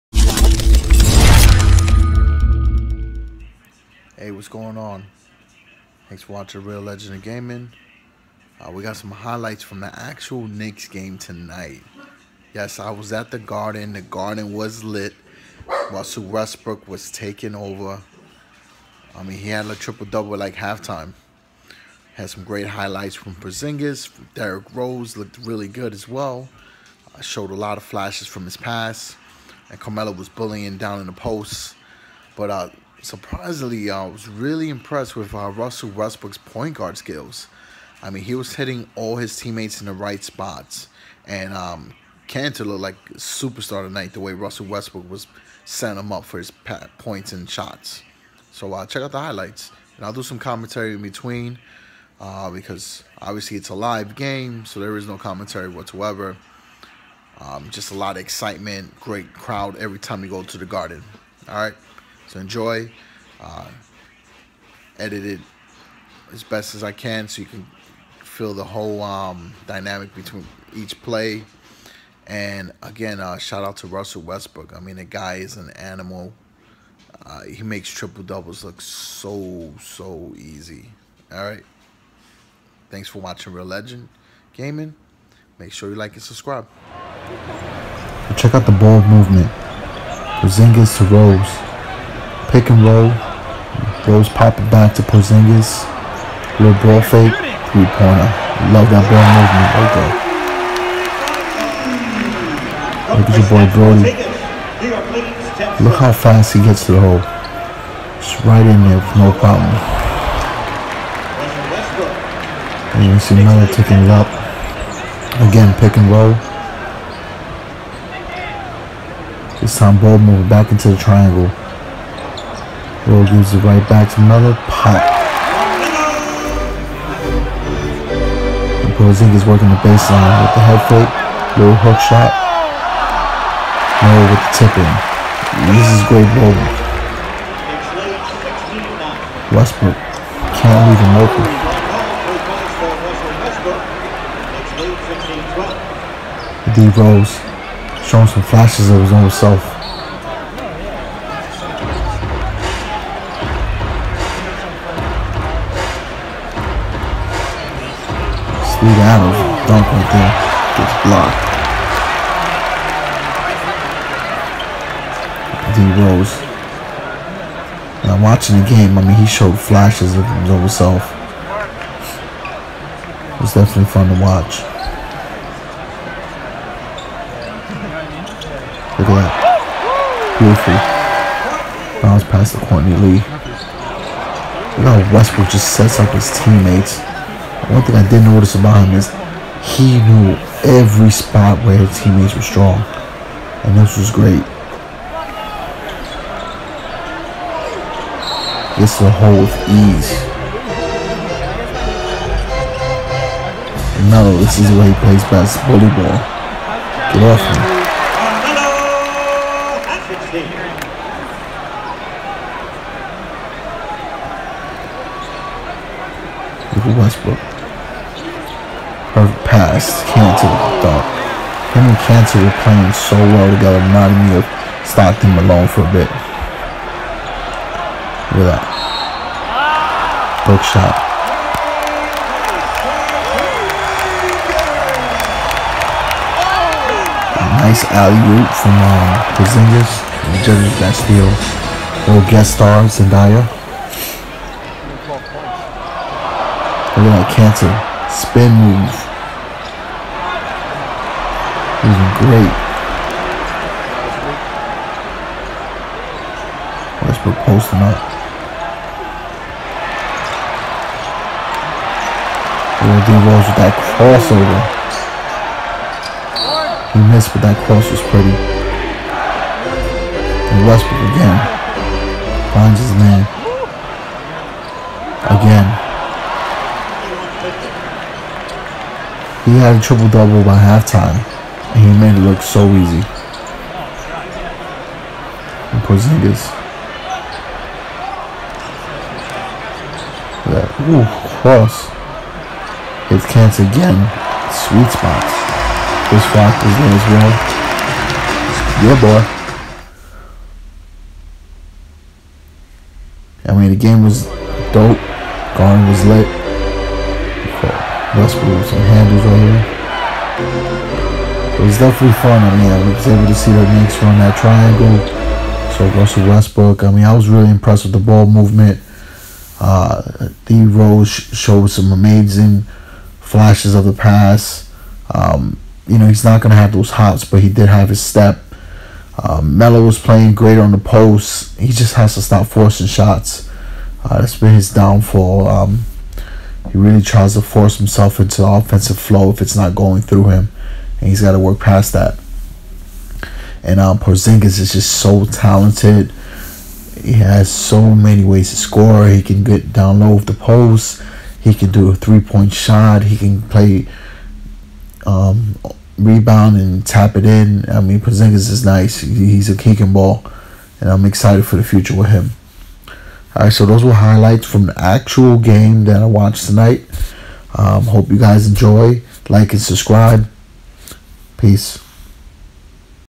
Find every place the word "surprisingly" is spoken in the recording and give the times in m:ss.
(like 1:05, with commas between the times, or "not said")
0:33.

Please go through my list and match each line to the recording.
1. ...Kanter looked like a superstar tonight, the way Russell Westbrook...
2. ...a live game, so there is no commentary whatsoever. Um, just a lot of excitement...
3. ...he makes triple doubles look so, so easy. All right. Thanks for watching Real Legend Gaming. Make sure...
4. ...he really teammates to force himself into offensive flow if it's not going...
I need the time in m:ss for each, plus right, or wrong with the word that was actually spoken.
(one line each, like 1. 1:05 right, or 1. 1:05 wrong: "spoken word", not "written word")
1. 0:42 right
2. 0:53 right
3. 1:17 right
4. 5:36 wrong: "tries", not "teammates".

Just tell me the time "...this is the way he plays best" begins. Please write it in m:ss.
3:24.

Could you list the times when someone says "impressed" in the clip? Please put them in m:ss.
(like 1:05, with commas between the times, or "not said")
0:34, 5:17.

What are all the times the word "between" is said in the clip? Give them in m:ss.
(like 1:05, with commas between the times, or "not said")
0:51, 1:10.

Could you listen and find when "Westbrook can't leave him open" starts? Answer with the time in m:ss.
2:19.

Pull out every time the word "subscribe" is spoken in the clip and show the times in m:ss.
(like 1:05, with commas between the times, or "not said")
1:26, 6:09.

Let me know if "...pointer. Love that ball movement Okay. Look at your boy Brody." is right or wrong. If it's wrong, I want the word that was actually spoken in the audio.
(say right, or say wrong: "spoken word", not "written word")
right.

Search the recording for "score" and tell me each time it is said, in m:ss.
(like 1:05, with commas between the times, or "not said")
5:48.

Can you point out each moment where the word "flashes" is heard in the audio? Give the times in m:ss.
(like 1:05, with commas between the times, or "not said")
0:27, 2:28, 2:49, 5:23.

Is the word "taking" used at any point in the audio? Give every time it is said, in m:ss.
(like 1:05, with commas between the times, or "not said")
0:17, 1:53.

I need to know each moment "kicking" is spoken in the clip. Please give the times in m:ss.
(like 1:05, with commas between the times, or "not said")
5:59.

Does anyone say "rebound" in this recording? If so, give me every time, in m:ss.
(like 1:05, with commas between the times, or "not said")
5:55.